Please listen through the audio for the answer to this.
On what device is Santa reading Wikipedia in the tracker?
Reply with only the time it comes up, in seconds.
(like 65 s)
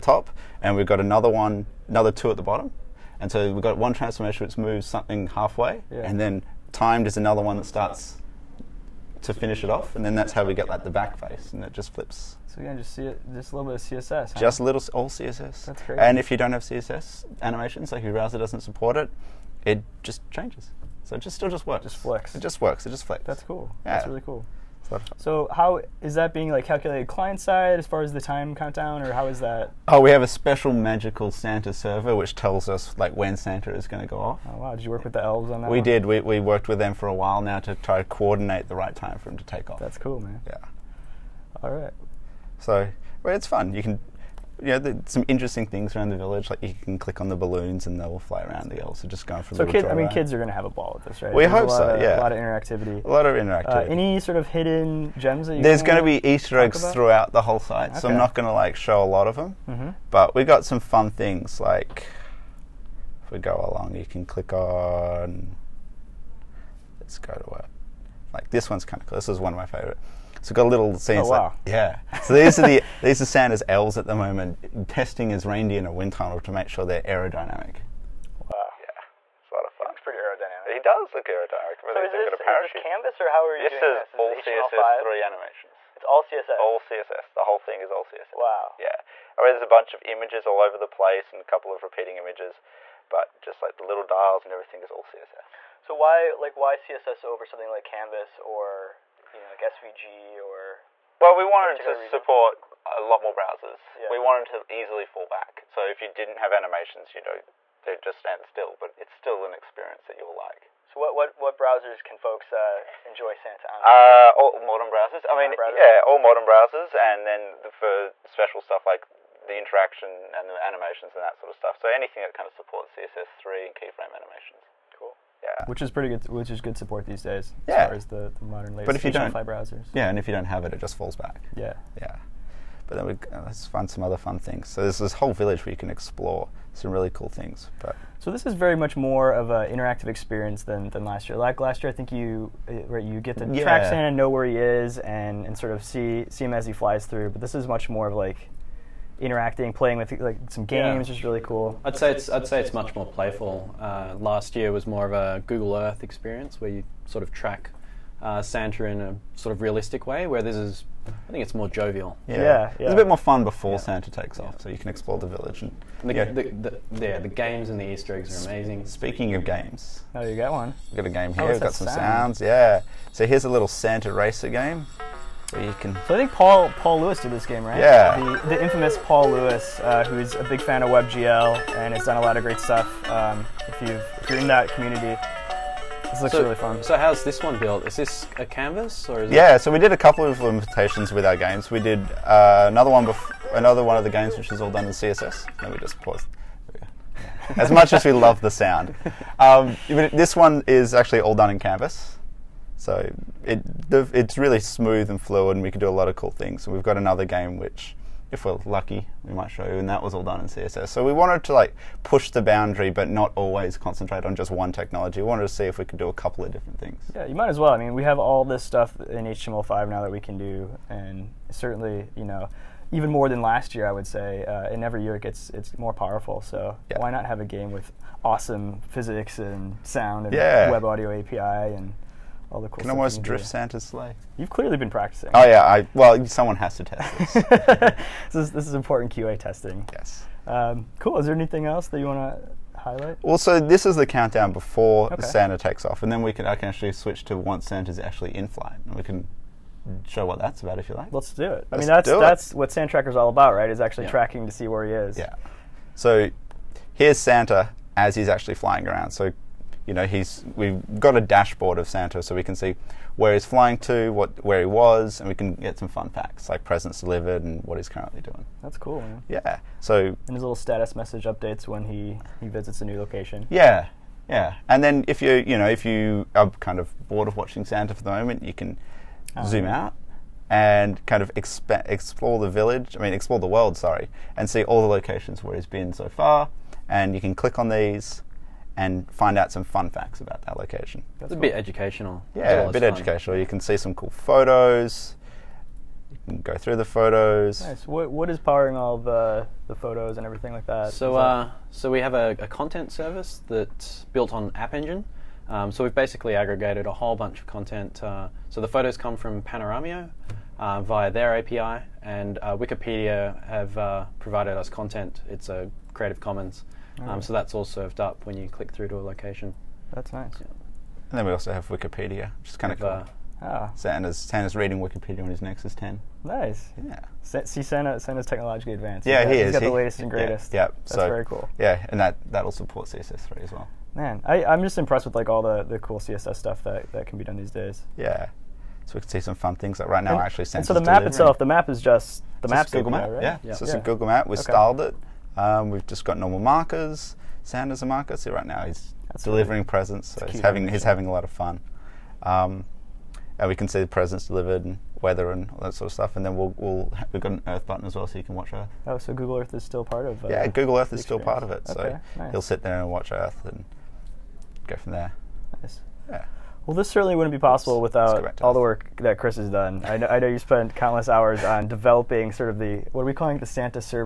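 325 s.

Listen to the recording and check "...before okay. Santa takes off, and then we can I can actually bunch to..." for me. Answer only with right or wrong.
wrong.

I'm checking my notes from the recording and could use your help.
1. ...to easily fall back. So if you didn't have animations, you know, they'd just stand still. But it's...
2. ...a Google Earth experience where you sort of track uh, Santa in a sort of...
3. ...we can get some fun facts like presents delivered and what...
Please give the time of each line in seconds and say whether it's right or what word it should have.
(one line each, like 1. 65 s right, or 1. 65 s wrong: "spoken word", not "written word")
1. 104 s right
2. 155 s right
3. 265 s right.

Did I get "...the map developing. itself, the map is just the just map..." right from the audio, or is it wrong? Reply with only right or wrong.
wrong.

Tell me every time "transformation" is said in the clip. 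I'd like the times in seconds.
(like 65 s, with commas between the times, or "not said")
3 s.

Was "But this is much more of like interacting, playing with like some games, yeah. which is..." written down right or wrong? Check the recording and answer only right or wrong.
right.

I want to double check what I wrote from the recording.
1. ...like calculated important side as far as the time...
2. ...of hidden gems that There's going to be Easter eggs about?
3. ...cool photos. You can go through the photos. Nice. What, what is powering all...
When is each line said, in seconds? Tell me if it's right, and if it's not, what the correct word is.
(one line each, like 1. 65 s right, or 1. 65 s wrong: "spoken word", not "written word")
1. 26 s wrong: "client", not "important"
2. 54 s right
3. 293 s right.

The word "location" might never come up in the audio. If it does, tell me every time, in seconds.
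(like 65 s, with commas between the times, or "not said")
272 s, 284 s, 290 s, 319 s.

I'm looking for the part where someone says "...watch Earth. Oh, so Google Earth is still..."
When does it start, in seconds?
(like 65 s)
358 s.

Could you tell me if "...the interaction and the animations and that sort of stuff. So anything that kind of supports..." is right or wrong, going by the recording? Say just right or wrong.
right.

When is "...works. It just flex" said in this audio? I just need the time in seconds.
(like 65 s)
22 s.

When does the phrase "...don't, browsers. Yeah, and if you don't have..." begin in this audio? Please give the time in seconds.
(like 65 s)
129 s.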